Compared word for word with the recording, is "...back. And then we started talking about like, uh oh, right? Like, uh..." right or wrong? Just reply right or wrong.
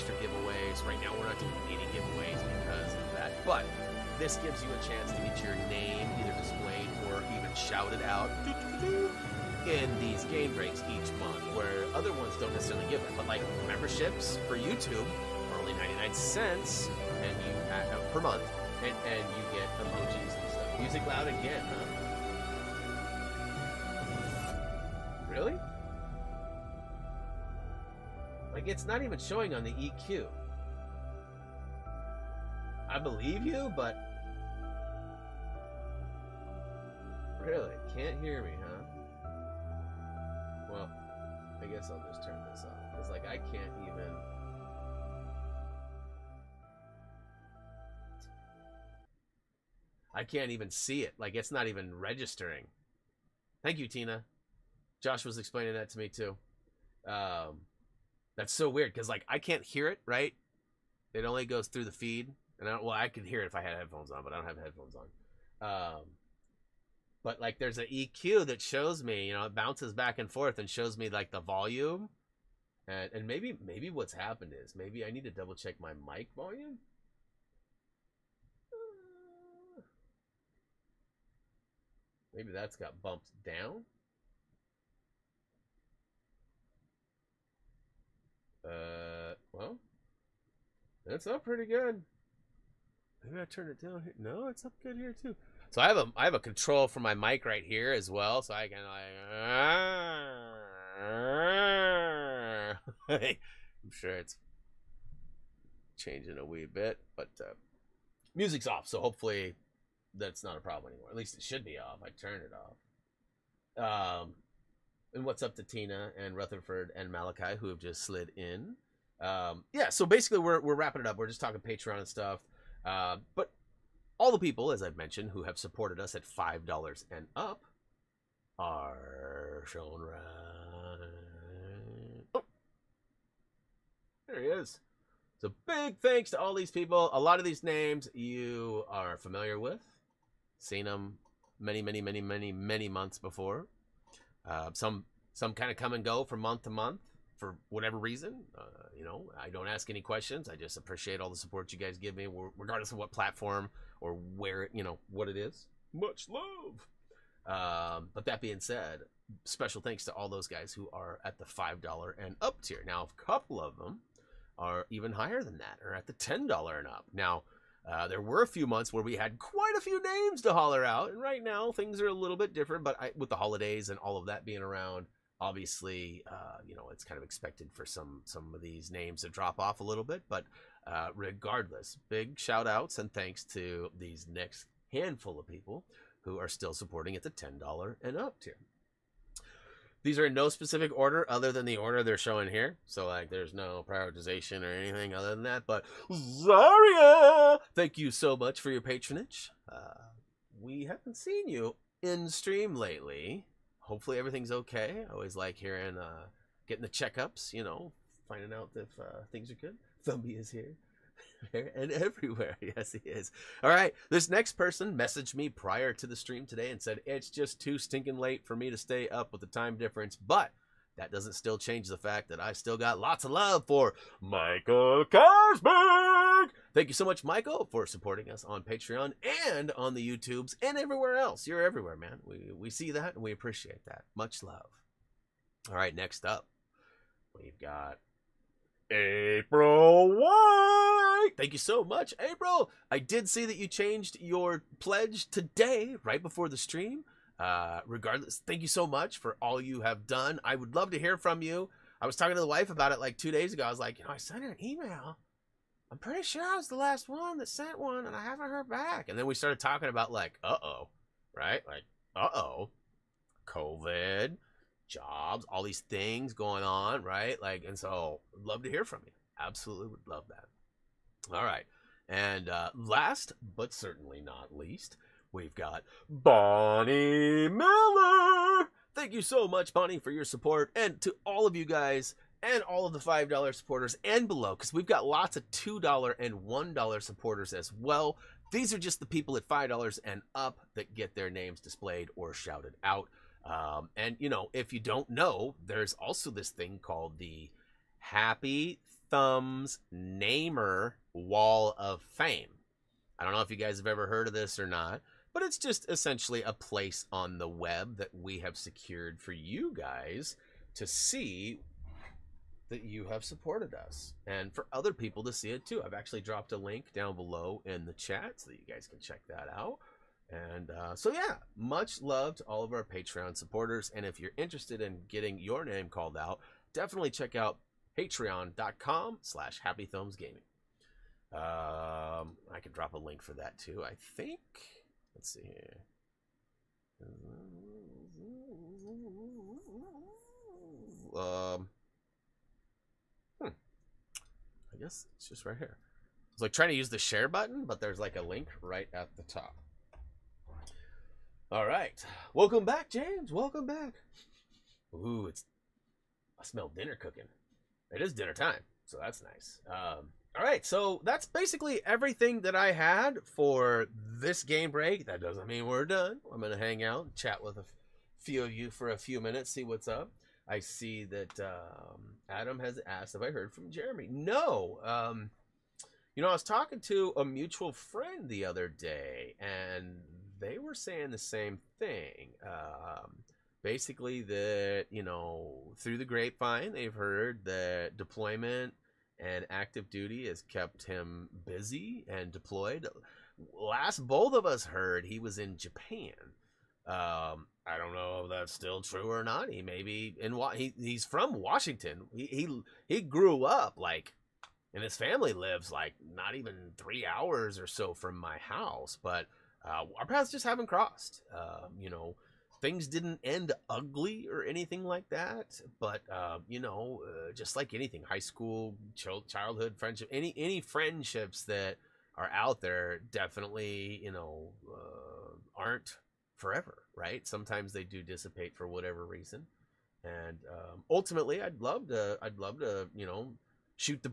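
right.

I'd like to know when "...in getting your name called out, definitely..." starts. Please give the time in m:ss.
5:24.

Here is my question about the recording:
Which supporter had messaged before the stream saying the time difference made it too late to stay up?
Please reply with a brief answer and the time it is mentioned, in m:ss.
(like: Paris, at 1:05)
Michael Cosberg, at 3:44.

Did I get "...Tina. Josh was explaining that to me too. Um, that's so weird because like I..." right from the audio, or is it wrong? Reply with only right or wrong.
right.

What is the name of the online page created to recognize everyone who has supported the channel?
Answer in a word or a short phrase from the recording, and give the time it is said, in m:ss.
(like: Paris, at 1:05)
Happy Thumbs Namer Wall of Fame, at 4:57.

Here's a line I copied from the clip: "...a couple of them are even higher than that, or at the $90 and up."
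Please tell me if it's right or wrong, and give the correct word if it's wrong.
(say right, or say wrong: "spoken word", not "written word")
wrong: "10", not "90".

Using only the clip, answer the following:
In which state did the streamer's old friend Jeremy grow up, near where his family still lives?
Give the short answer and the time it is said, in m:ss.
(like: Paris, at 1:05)
Washington, at 6:41.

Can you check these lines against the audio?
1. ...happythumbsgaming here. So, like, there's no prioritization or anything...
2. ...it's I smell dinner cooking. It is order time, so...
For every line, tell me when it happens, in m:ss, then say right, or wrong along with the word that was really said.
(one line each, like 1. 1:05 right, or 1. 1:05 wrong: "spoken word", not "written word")
1. 3:12 wrong: "showing", not "happythumbsgaming"
2. 5:55 wrong: "dinner", not "order".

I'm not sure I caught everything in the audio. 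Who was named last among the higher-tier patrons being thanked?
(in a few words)
Bonnie Miller.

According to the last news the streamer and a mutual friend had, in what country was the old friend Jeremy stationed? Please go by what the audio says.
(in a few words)
Japan.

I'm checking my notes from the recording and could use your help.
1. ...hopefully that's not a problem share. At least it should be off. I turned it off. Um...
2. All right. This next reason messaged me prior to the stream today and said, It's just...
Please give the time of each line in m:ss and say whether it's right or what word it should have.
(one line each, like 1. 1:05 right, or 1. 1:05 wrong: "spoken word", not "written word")
1. 1:49 wrong: "anymore", not "share"
2. 3:33 wrong: "person", not "reason".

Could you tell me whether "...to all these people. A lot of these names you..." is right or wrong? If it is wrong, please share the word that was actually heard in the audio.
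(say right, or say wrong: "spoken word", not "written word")
right.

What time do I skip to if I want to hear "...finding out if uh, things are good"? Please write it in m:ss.
3:28.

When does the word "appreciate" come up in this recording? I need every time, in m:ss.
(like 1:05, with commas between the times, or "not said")
2:30, 3:53.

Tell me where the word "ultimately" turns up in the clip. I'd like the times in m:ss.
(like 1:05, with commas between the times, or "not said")
7:10.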